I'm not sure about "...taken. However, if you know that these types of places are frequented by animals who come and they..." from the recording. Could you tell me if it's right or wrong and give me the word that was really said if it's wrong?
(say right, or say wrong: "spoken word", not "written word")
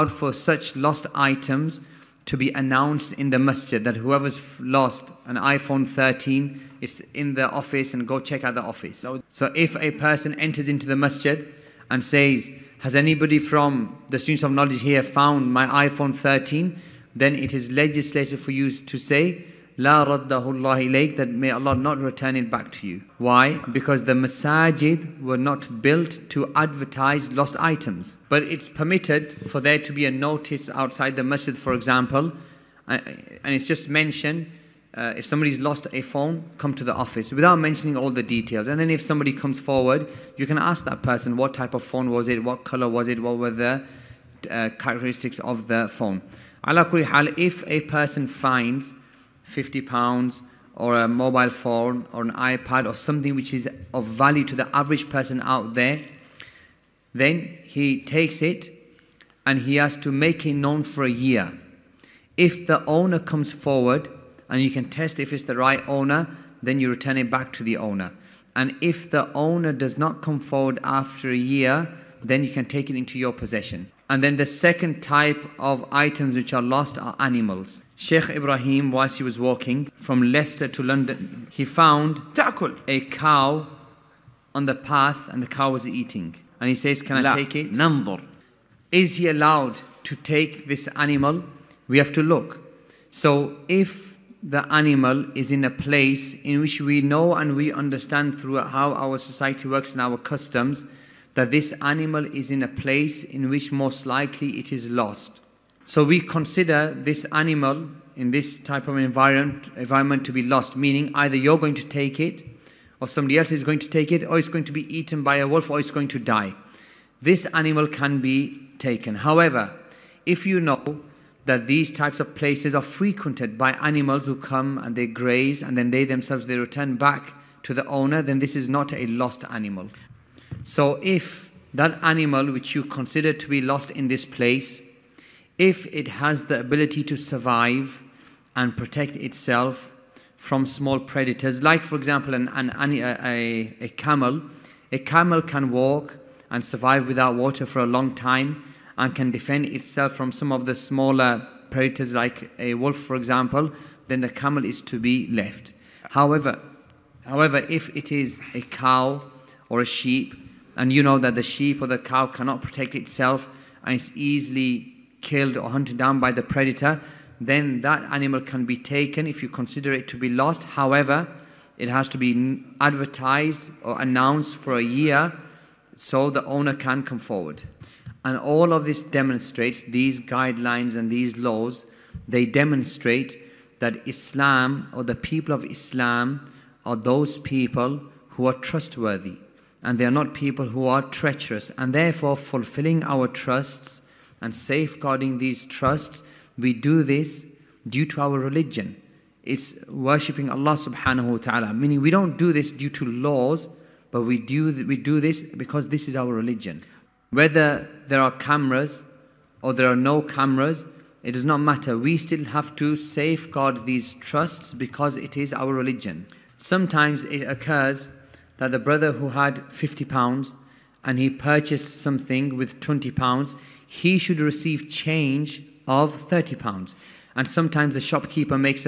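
right.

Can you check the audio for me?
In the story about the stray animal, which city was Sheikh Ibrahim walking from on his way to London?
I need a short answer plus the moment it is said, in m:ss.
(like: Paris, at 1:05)
Leicester, at 1:20.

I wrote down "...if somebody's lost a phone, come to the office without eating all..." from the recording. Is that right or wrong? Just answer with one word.
wrong.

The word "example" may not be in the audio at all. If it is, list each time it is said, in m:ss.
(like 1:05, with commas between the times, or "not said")
0:31, 2:21, 2:33.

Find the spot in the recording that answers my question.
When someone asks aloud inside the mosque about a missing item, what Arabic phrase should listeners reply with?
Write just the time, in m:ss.
0:19.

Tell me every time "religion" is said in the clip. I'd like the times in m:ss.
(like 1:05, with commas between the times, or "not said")
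3:18, 3:26, 3:35.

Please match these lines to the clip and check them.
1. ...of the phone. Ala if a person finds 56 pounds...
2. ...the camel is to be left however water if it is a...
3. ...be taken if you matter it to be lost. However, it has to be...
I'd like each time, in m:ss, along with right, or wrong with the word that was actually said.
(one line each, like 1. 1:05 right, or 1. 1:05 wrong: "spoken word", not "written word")
1. 0:45 wrong: "50", not "56"
2. 2:34 wrong: "however", not "water"
3. 2:48 wrong: "consider", not "matter".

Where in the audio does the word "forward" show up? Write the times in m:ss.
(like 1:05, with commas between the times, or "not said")
0:39, 1:03, 1:10, 2:57.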